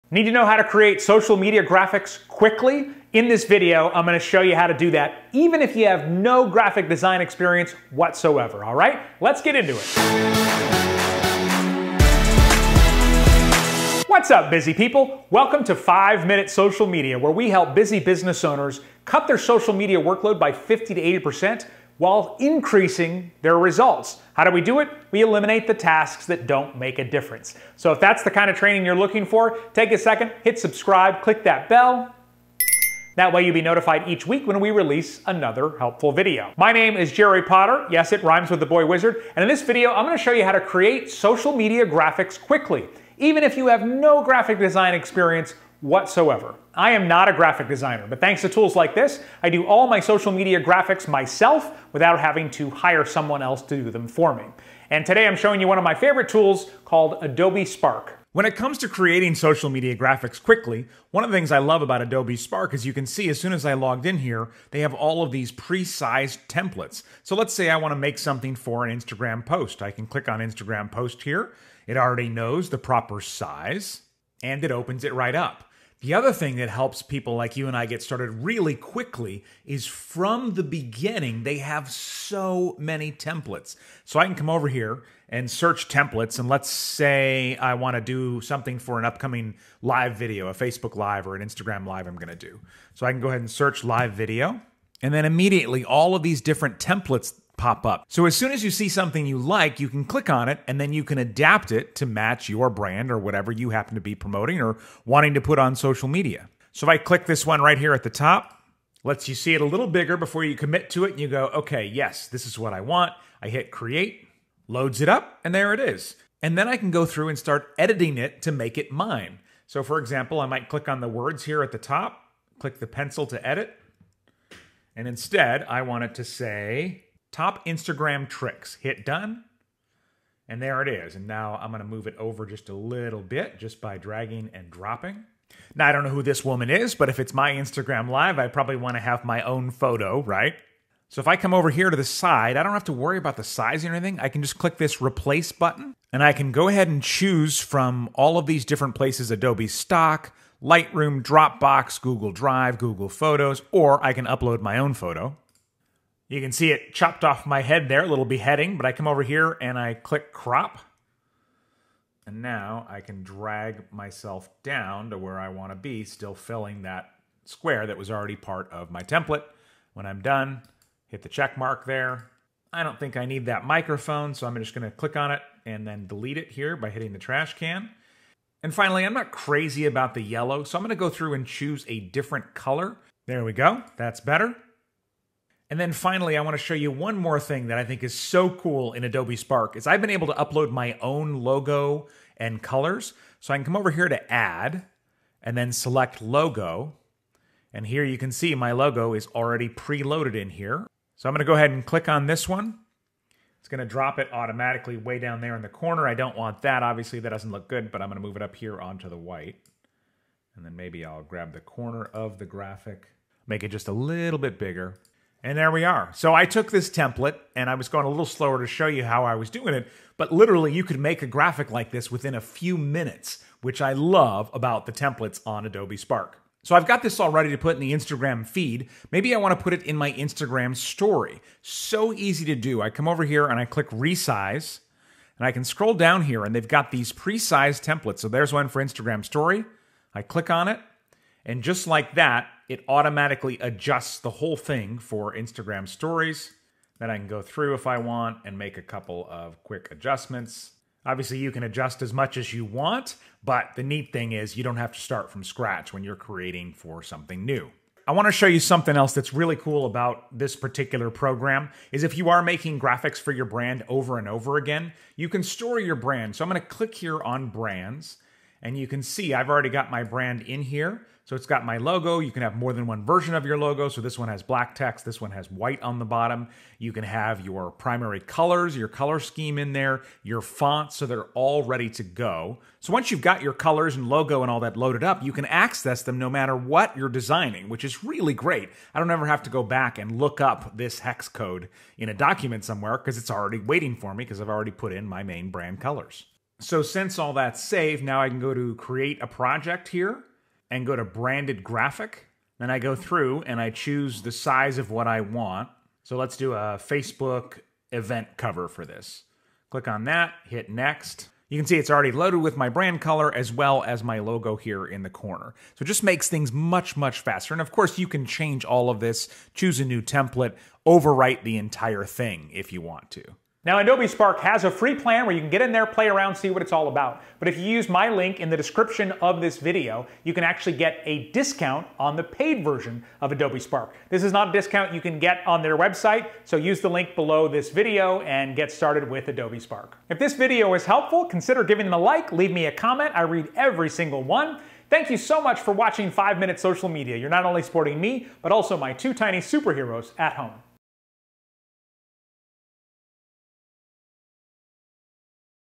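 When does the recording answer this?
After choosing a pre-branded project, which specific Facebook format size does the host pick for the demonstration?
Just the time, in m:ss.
5:06.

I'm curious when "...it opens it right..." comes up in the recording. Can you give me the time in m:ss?
1:14.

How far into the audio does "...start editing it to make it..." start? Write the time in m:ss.
1:57.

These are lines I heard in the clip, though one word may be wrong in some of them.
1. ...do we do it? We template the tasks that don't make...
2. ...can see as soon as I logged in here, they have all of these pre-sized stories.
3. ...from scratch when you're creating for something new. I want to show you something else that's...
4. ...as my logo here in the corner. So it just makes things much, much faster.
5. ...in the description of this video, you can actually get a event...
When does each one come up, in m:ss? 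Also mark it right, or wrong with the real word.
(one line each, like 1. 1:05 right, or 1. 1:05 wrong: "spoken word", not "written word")
1. 0:24 wrong: "eliminate", not "template"
2. 1:02 wrong: "templates", not "stories"
3. 4:15 right
4. 5:13 right
5. 5:28 wrong: "discount", not "event".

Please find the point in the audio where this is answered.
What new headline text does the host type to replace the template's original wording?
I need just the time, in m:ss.
2:07.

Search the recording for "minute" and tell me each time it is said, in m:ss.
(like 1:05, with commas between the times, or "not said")
0:16, 3:42, 5:46.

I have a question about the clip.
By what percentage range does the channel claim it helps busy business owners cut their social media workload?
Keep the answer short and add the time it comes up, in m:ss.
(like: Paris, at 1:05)
50 to 80%, at 0:20.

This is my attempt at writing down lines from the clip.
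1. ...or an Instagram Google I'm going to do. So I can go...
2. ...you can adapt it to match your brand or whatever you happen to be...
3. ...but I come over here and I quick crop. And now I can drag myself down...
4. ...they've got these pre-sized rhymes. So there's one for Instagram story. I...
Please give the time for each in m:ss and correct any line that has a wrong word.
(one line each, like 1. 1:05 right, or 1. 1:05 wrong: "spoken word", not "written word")
1. 1:31 wrong: "Live", not "Google"
2. 1:40 right
3. 2:38 wrong: "click", not "quick"
4. 3:56 wrong: "templates", not "rhymes".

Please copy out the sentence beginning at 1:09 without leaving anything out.
I can click on Instagram post here.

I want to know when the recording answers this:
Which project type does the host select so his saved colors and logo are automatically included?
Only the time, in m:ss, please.
5:01.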